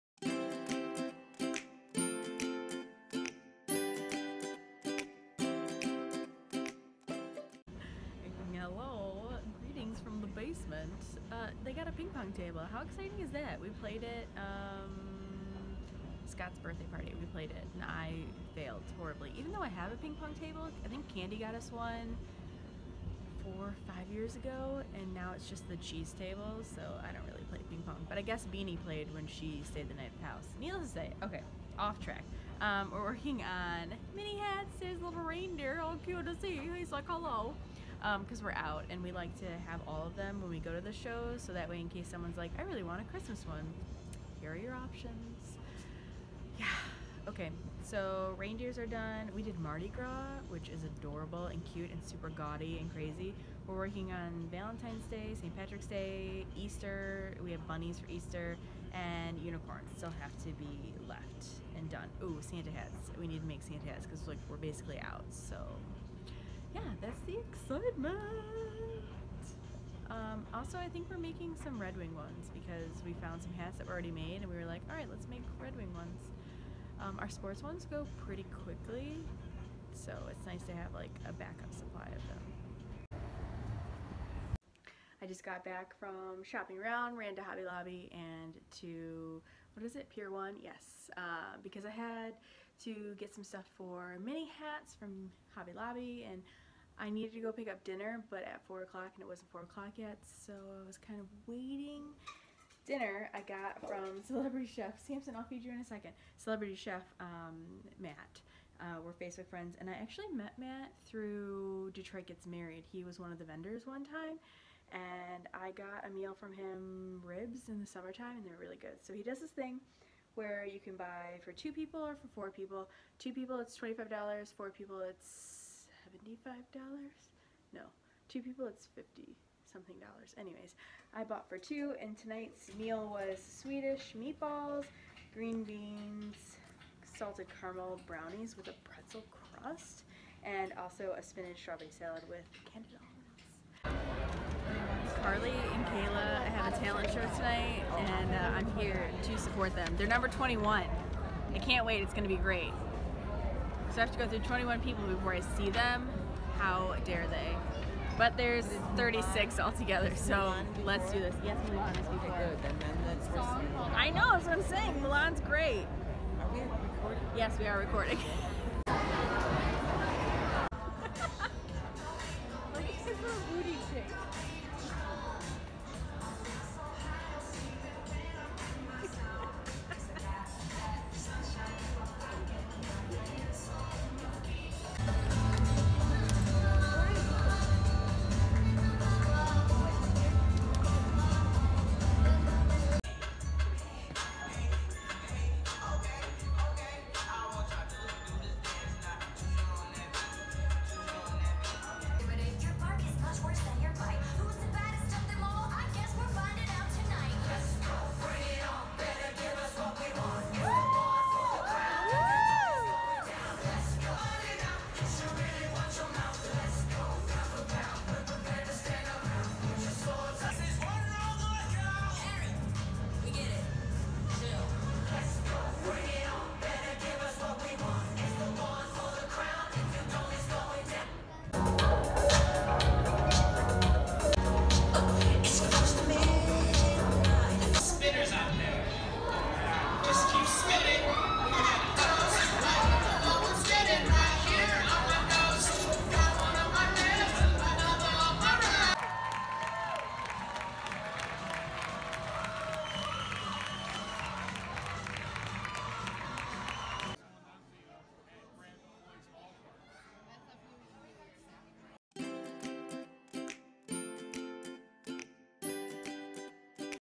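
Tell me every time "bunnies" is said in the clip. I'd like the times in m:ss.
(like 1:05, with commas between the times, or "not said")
0:57.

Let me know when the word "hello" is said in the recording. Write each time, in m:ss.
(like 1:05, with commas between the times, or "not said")
0:08, 0:37.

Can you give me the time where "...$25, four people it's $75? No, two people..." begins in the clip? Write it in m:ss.
2:03.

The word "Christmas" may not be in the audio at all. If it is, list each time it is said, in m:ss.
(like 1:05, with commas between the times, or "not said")
0:43.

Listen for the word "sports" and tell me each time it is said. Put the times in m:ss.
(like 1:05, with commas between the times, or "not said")
1:17.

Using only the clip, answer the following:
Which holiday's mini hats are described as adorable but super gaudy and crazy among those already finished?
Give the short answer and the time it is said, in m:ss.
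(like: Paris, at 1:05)
Mardi Gras, at 0:49.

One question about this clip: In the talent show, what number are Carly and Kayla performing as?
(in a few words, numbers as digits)
21.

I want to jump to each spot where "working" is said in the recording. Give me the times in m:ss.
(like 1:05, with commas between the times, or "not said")
0:33, 0:53.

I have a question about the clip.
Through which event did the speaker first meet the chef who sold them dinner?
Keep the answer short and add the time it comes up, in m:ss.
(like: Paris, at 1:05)
Detroit Gets Married, at 1:51.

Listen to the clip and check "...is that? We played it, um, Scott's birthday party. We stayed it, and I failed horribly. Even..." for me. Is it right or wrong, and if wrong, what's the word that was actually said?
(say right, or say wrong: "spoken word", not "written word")
wrong: "played", not "stayed".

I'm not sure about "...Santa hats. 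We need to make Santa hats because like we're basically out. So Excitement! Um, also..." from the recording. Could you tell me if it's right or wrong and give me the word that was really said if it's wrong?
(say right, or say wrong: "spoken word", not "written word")
right.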